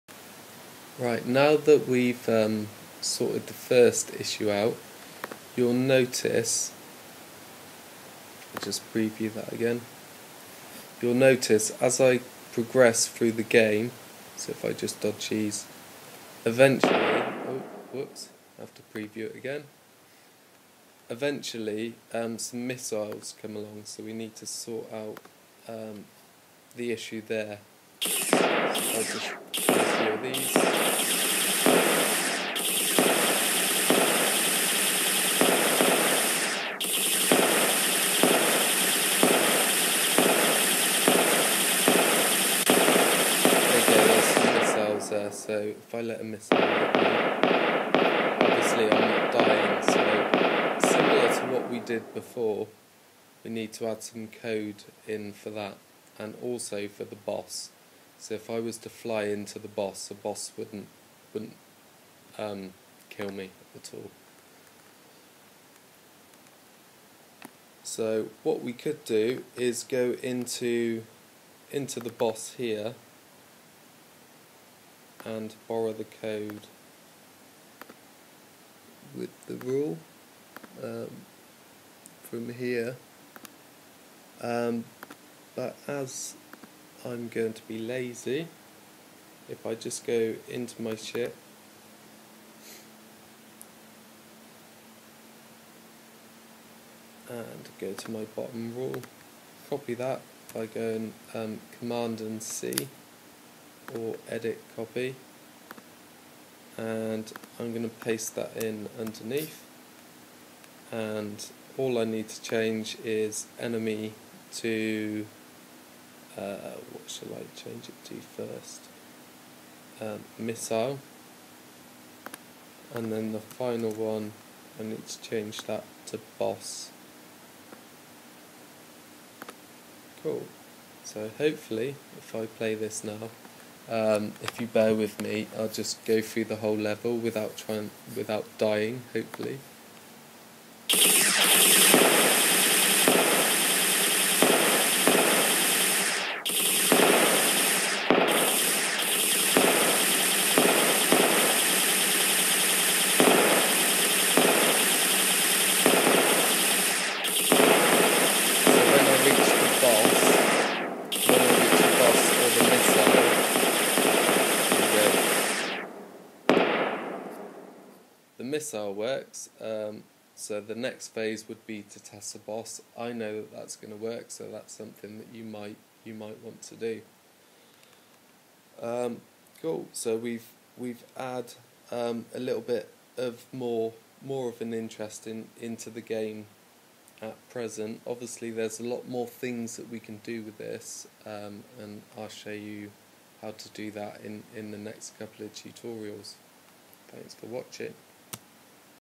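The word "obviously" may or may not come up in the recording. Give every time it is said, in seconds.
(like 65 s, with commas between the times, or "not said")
48 s, 188 s.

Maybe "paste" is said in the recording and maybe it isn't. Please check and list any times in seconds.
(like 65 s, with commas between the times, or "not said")
108 s.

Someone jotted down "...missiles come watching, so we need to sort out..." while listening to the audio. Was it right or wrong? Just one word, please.
wrong.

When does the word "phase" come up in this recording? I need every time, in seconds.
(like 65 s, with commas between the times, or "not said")
171 s.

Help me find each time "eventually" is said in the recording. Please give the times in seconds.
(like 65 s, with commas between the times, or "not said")
16 s, 21 s.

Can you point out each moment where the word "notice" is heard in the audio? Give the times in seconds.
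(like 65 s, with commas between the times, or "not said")
5 s, 11 s.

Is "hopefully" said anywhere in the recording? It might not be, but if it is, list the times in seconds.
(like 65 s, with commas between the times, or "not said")
131 s, 139 s.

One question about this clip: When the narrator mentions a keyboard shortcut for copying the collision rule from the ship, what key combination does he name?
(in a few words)
Command and C.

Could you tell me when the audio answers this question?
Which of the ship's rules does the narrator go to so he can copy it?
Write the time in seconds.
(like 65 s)
98 s.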